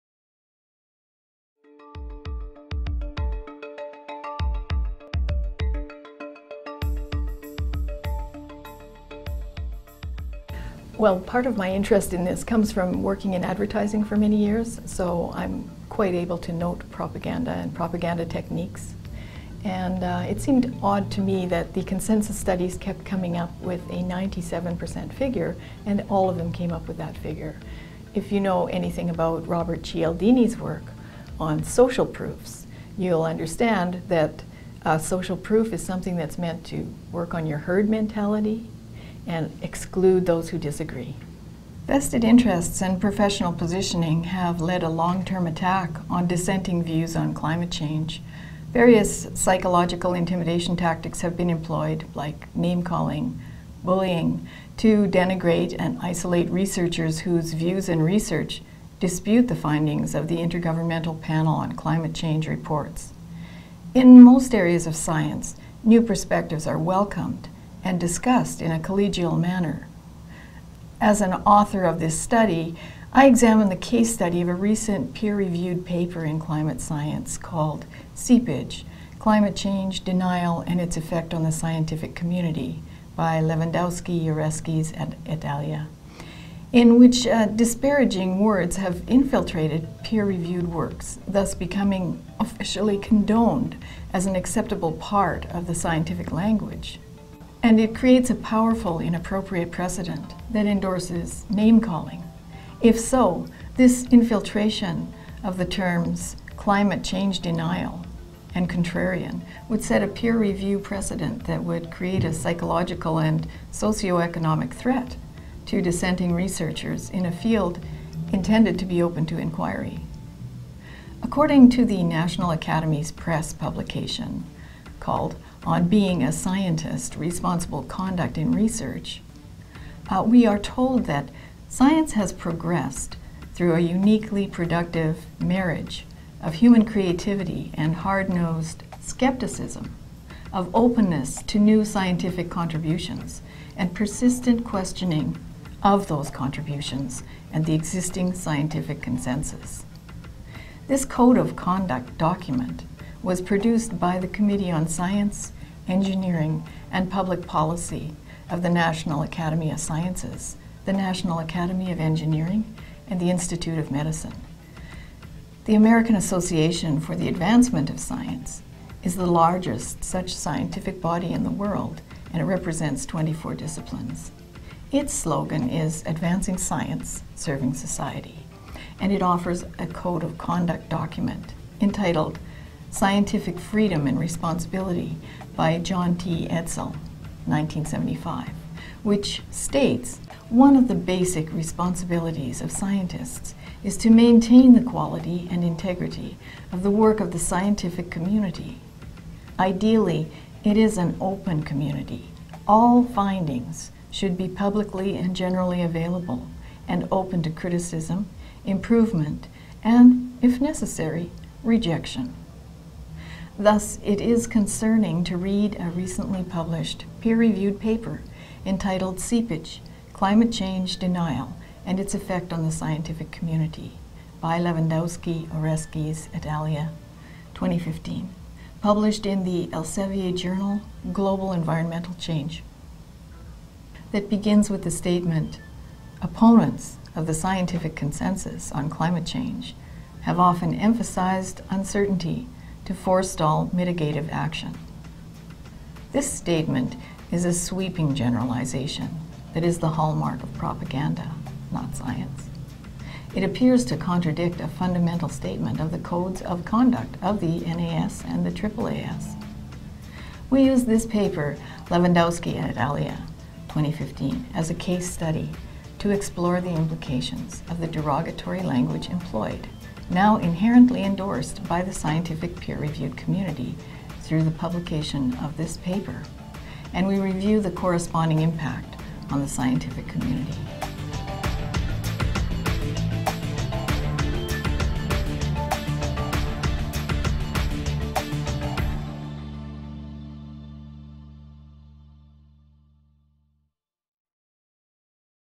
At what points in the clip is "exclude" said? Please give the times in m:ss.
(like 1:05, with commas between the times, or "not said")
0:39.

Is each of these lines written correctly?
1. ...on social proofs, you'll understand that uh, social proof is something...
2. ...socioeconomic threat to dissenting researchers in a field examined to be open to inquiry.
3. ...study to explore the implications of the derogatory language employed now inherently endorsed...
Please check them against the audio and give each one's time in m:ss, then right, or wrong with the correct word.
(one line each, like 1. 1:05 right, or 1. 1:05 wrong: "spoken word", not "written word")
1. 0:31 right
2. 1:53 wrong: "intended", not "examined"
3. 4:25 right.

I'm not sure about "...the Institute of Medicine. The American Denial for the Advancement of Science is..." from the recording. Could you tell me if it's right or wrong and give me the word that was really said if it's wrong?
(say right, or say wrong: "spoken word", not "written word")
wrong: "Association", not "Denial".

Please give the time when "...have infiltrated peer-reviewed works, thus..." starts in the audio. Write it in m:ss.
1:28.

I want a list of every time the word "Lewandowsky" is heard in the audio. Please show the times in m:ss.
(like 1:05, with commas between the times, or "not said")
1:23, 3:44, 4:21.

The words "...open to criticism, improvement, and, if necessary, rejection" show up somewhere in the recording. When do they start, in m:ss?
3:27.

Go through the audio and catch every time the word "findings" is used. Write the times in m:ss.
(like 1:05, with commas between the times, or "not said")
0:59, 3:23.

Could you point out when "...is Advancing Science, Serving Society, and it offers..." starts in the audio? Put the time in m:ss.
2:55.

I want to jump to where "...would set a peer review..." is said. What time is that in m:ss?
1:49.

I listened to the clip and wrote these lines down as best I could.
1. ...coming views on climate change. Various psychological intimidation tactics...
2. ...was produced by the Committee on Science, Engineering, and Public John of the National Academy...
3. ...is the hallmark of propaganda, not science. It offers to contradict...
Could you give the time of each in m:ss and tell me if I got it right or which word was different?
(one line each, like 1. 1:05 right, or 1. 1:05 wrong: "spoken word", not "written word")
1. 0:46 wrong: "dissenting", not "coming"
2. 2:33 wrong: "Policy", not "John"
3. 4:09 wrong: "appears", not "offers".